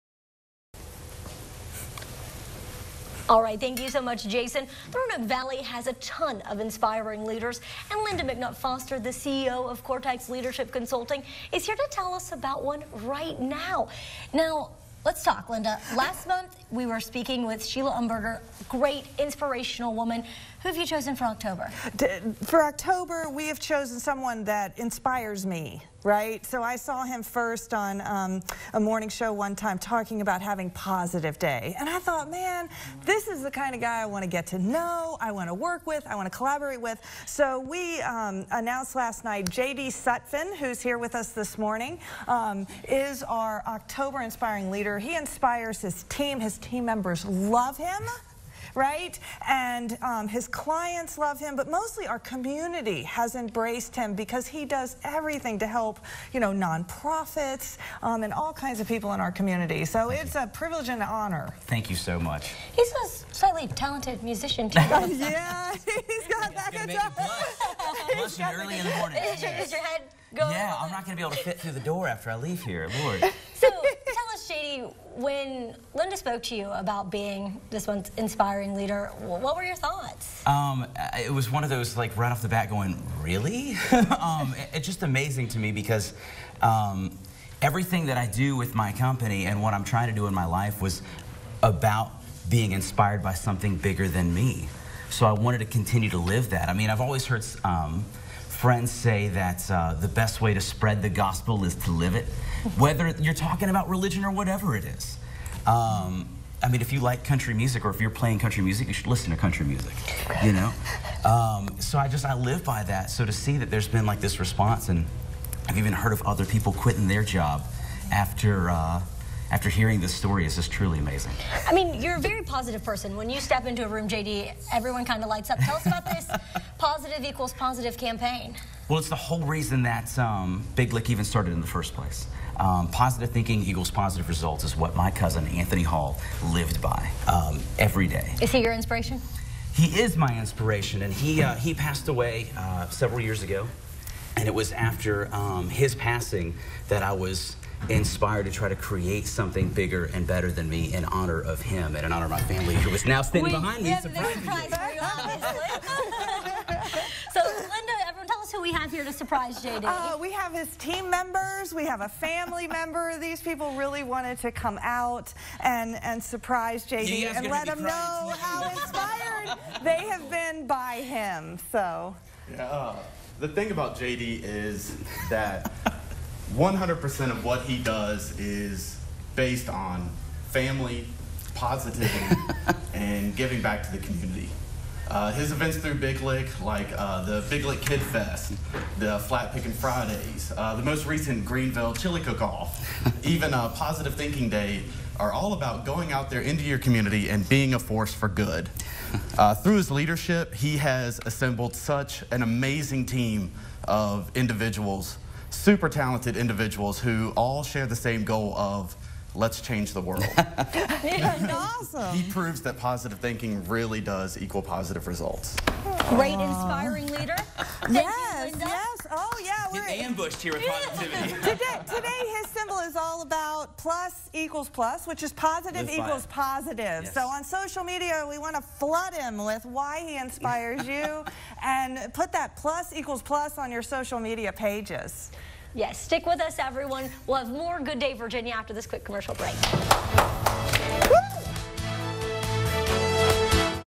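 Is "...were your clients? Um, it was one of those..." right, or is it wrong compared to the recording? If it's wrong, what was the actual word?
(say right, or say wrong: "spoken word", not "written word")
wrong: "thoughts", not "clients".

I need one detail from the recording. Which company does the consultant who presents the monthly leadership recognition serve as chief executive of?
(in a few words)
Cortex Leadership Consulting.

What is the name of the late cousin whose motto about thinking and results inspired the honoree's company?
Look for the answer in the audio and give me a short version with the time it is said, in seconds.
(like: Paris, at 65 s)
Anthony Hall, at 135 s.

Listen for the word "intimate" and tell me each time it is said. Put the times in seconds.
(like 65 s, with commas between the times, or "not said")
not said.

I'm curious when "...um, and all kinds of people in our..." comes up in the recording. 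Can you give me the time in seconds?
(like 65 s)
58 s.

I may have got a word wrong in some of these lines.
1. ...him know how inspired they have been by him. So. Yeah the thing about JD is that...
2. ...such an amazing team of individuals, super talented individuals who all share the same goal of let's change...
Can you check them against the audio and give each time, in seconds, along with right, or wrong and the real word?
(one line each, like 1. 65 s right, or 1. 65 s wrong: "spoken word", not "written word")
1. 167 s right
2. 201 s right.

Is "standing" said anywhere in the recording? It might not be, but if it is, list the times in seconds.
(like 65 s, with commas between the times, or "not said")
153 s.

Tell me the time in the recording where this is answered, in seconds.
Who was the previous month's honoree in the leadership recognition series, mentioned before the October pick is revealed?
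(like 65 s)
17 s.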